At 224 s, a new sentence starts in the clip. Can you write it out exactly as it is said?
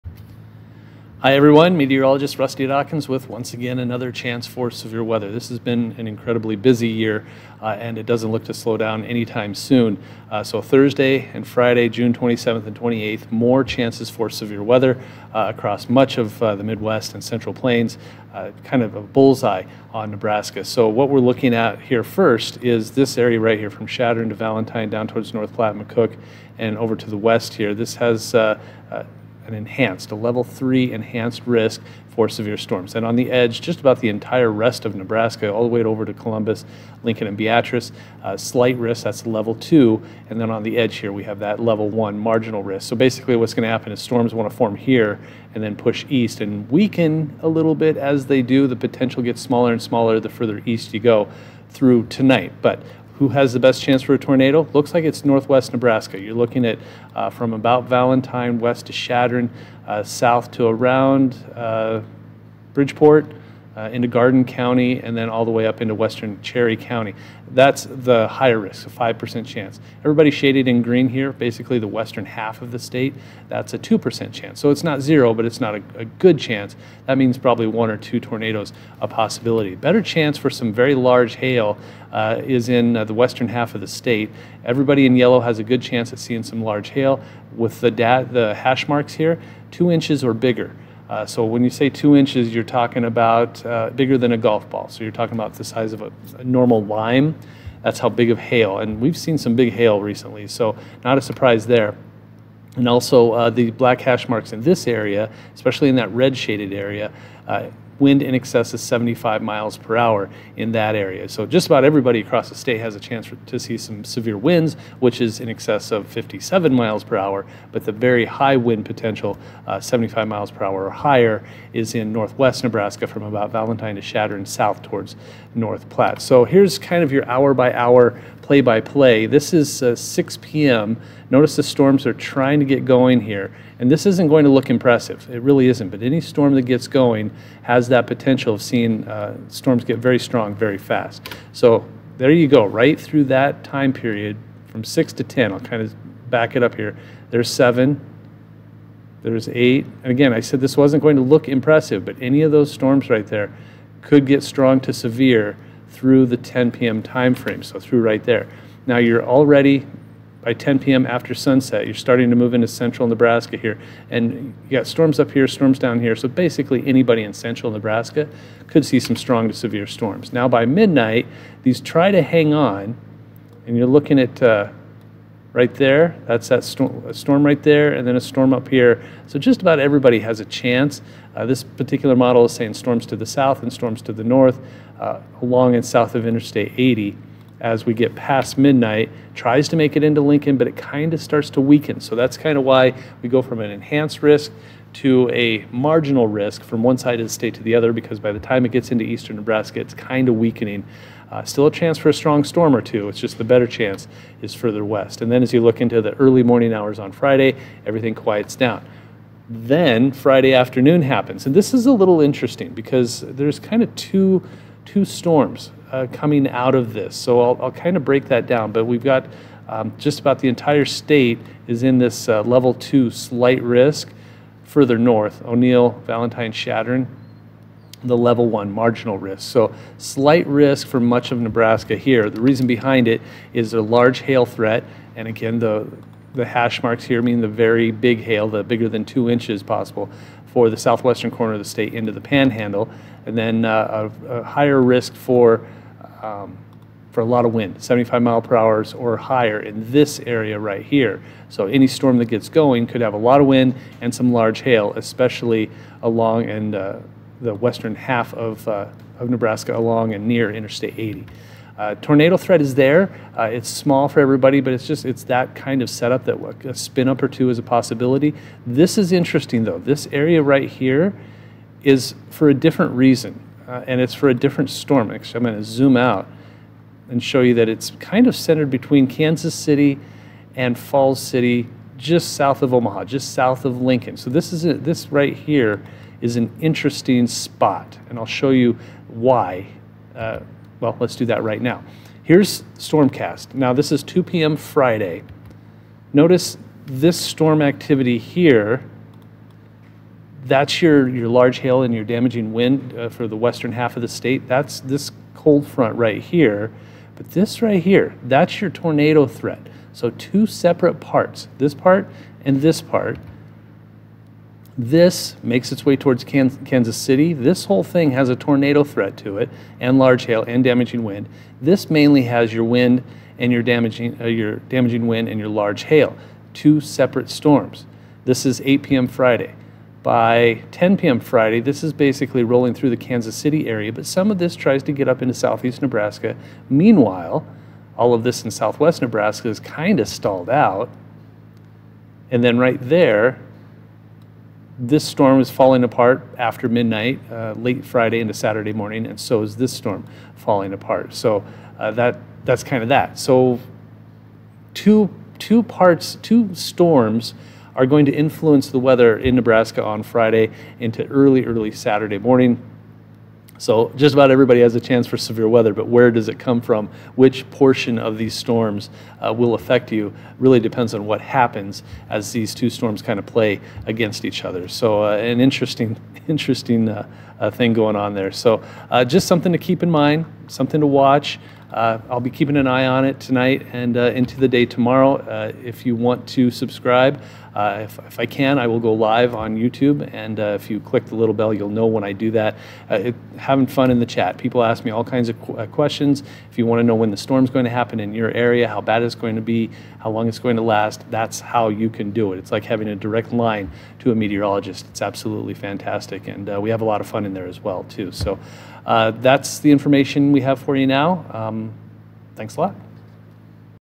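Further north, O'Neill, Valentine, Chadron, the level one marginal risk.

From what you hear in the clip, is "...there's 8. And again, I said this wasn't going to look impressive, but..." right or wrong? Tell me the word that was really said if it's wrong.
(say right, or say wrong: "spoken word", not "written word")
right.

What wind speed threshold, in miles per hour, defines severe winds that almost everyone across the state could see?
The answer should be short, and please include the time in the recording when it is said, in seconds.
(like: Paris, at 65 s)
57, at 116 s.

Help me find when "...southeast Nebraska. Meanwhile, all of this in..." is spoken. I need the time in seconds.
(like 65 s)
335 s.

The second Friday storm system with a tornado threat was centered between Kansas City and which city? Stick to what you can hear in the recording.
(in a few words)
Falls City.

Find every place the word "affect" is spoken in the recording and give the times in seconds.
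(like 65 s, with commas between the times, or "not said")
369 s.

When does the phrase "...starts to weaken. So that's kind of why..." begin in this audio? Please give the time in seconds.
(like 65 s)
191 s.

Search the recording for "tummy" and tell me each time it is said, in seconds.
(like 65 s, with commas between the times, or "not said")
not said.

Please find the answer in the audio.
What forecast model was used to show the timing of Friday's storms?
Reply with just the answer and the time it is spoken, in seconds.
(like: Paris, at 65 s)
Stormcast, at 292 s.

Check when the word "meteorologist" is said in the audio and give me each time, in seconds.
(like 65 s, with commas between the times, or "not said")
1 s, 404 s.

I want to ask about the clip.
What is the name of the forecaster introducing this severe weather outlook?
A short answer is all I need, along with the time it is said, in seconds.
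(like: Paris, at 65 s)
Rusty Dawkins, at 2 s.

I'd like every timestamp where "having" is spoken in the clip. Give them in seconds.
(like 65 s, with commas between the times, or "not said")
393 s, 402 s.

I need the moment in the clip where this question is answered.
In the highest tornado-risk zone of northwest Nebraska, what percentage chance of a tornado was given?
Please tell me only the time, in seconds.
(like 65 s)
68 s.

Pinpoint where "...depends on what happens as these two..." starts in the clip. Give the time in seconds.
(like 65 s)
370 s.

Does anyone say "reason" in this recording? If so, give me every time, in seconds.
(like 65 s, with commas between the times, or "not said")
232 s, 272 s.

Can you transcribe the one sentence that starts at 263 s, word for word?
Uh, it's small for everybody, but it's just it's that kind of setup that a spin up or two is a possibility.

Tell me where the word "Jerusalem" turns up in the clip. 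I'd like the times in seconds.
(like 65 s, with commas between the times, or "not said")
not said.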